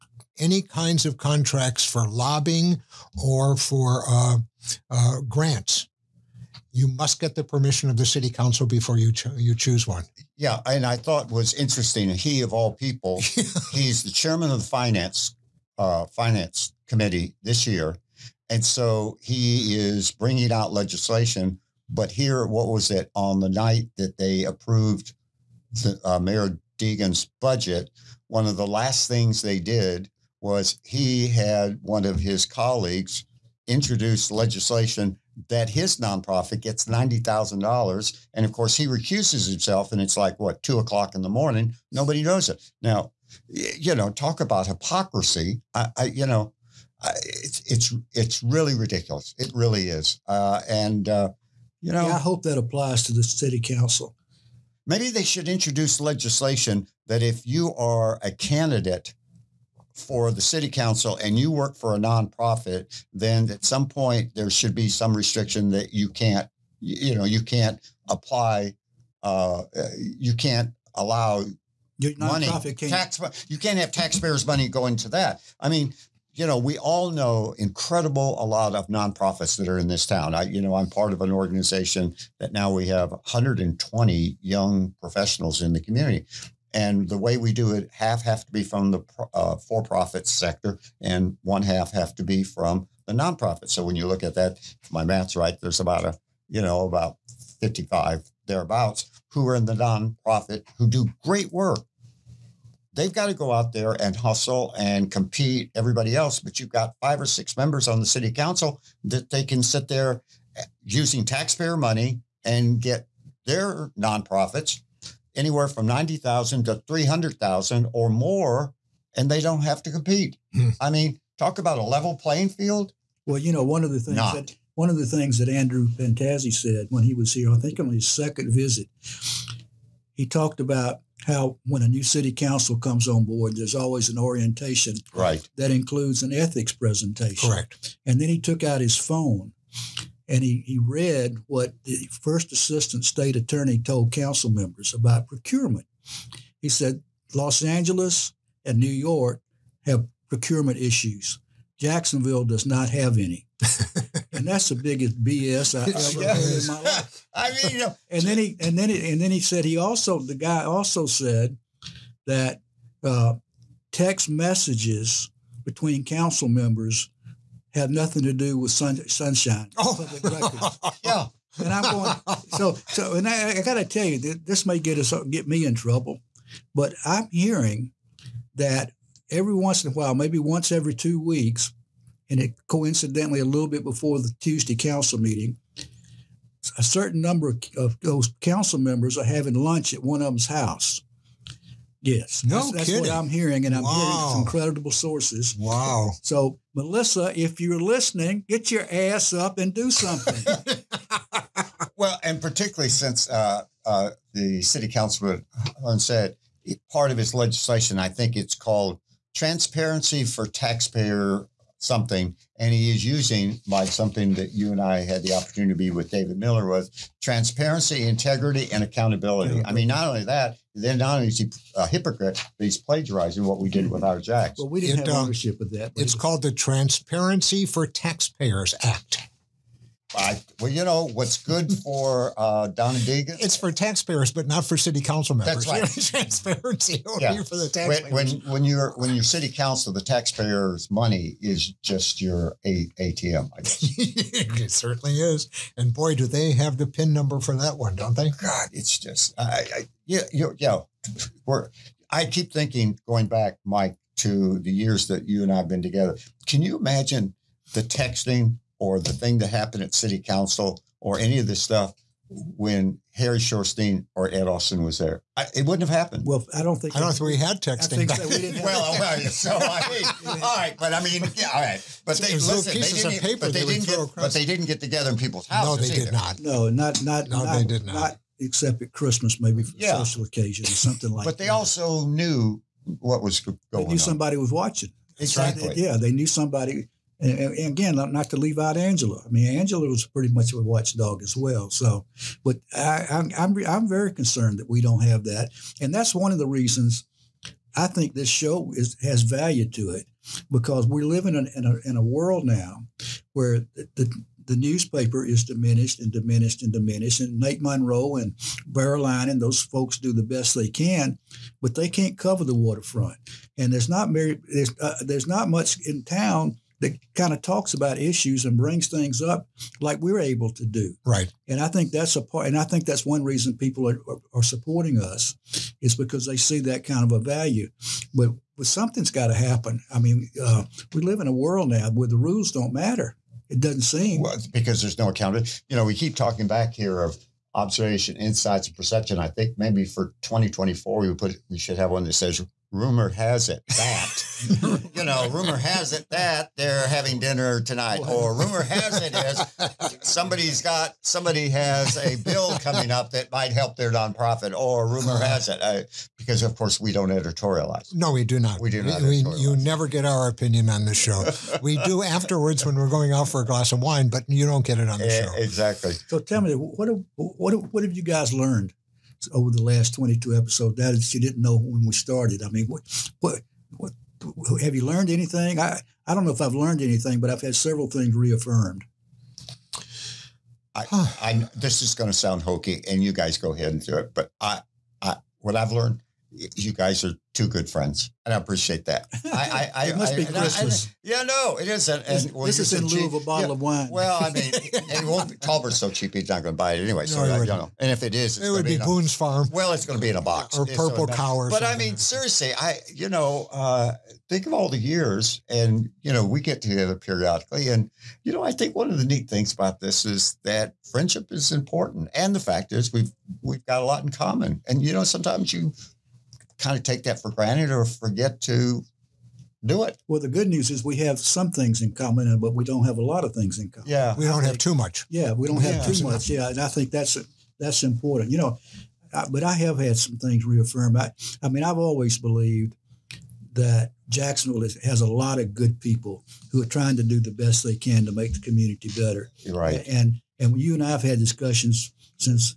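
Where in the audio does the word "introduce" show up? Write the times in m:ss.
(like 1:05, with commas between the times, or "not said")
0:33, 0:55.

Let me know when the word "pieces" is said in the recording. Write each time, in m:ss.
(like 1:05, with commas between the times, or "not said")
4:32.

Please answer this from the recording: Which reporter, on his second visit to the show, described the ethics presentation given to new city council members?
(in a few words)
Andrew Pantazi.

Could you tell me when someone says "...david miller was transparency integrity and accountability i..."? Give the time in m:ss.
3:36.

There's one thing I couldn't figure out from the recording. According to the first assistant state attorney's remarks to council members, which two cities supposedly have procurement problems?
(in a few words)
Los Angeles and New York.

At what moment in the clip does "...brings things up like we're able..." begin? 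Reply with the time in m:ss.
5:18.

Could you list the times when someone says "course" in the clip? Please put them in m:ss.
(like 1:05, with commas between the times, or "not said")
0:38, 5:56.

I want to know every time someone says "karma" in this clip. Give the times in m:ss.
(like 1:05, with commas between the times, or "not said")
not said.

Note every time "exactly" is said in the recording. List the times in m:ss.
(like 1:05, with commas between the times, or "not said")
4:45, 6:05.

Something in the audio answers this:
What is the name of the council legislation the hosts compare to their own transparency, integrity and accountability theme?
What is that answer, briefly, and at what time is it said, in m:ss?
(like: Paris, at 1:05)
Transparency for Taxpayers Act, at 3:46.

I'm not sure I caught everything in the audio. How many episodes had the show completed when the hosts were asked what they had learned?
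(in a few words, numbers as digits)
22.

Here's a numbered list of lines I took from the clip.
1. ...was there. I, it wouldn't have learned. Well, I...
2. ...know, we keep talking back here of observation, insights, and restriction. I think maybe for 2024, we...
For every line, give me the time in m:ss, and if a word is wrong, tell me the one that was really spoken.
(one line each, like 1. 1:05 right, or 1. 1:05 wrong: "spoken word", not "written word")
1. 4:24 wrong: "happened", not "learned"
2. 5:35 wrong: "perception", not "restriction".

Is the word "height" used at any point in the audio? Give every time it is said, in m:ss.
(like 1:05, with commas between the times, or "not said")
not said.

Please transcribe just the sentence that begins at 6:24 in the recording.
But I, I, what I've learned you guys are two good friends, and I appreciate that.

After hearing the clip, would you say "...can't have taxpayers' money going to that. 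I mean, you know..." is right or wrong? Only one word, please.
right.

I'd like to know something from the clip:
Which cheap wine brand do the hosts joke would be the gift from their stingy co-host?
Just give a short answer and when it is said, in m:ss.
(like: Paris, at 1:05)
Boone's Farm, at 6:38.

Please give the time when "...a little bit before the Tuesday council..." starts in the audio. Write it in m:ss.
3:03.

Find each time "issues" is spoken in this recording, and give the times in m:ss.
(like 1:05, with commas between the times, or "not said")
2:30, 5:17.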